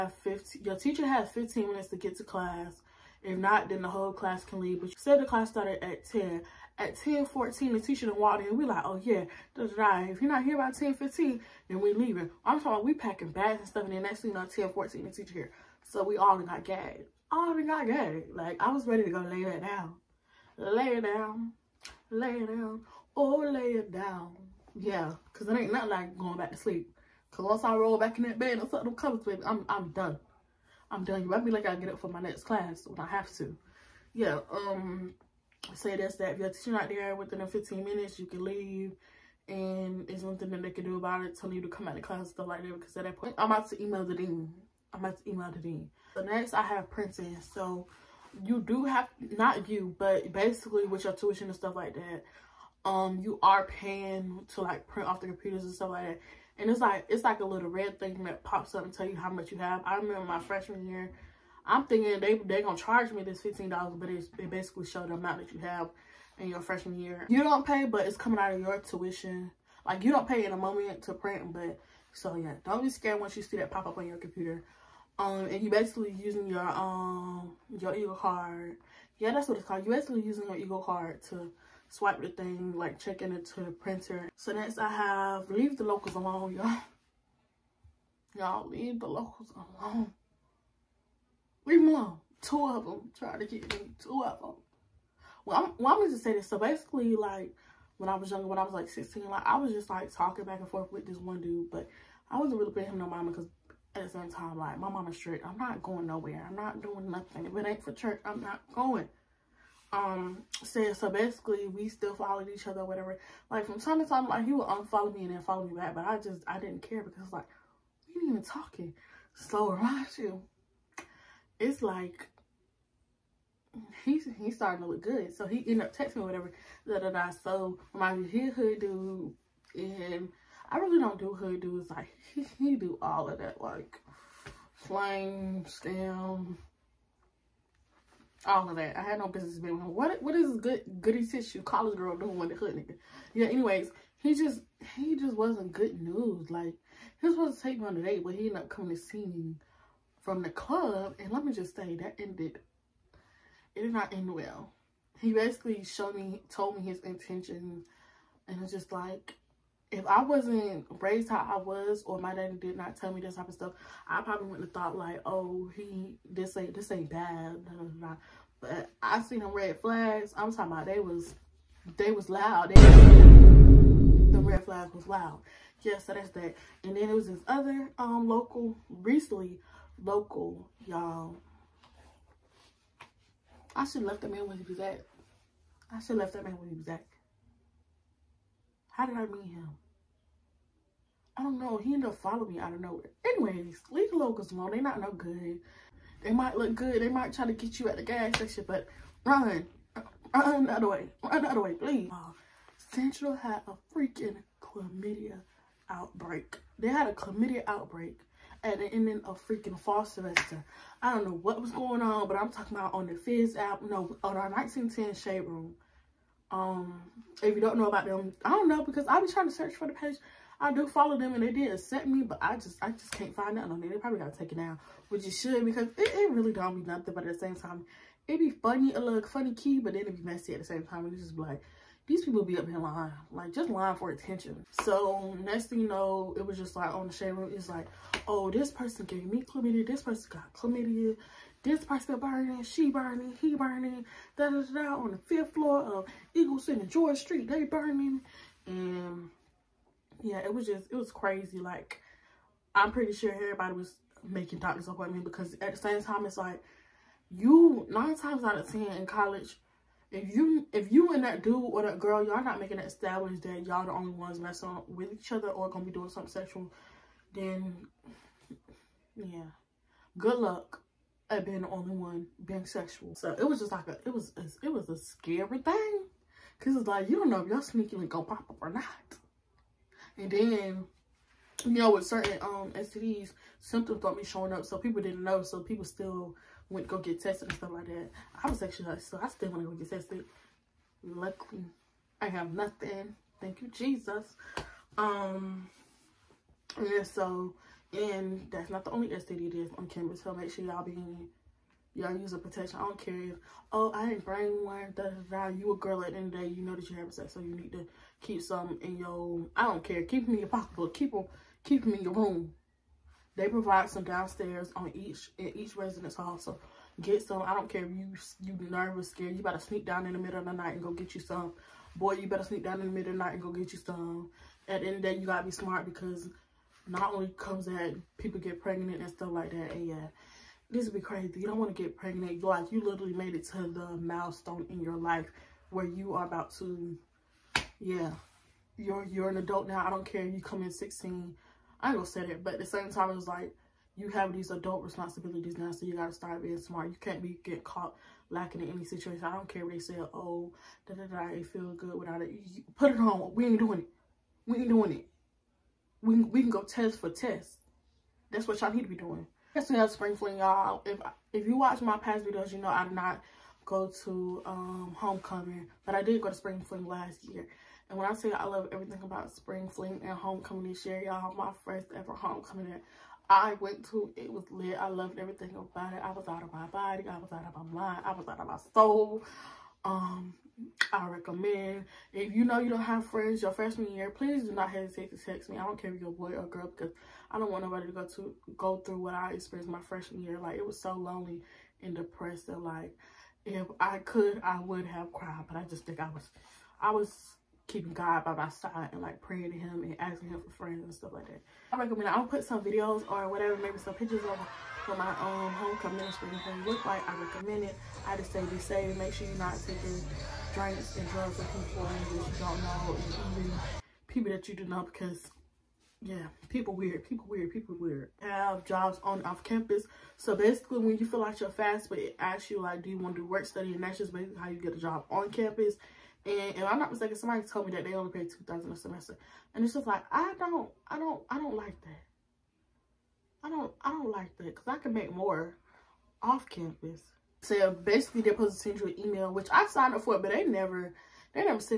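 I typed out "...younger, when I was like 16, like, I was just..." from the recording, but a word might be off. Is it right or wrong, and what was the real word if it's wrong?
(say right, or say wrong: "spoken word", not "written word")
right.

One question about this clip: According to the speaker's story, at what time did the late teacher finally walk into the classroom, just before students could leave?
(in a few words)
10:14.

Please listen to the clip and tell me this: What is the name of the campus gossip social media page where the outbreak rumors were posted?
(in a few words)
1910 Shade Room.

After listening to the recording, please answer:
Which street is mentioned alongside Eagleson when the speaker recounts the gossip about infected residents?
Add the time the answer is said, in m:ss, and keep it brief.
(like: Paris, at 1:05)
George Street, at 4:06.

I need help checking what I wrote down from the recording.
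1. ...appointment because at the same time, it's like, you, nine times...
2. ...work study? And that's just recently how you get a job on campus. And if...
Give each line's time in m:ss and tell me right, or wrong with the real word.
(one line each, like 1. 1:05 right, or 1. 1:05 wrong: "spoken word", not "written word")
1. 4:14 right
2. 7:03 wrong: "basically", not "recently".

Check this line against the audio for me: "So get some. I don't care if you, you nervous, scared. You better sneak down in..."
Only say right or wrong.
right.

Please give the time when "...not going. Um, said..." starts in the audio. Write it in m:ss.
1:48.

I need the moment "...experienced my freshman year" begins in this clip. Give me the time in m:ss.
6:29.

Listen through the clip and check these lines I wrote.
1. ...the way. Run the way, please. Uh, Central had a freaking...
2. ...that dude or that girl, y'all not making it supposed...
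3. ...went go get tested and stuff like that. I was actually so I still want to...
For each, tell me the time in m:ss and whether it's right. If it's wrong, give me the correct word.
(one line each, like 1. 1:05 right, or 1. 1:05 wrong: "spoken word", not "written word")
1. 3:20 right
2. 4:21 wrong: "established", not "supposed"
3. 4:46 right.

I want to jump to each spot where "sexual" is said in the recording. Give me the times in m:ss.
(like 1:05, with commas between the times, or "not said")
4:26, 4:32.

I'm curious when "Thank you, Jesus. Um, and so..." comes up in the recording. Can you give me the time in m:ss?
4:53.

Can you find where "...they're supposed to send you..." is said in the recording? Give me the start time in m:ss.
7:18.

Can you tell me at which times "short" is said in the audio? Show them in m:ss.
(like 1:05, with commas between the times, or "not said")
not said.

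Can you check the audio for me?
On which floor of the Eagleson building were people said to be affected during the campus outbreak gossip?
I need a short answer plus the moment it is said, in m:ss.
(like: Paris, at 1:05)
fifth floor, at 4:05.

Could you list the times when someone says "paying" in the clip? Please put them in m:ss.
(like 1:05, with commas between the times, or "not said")
0:53, 1:42.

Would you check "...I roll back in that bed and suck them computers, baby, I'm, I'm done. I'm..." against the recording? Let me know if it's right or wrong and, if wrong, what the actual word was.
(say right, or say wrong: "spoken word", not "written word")
wrong: "covers", not "computers".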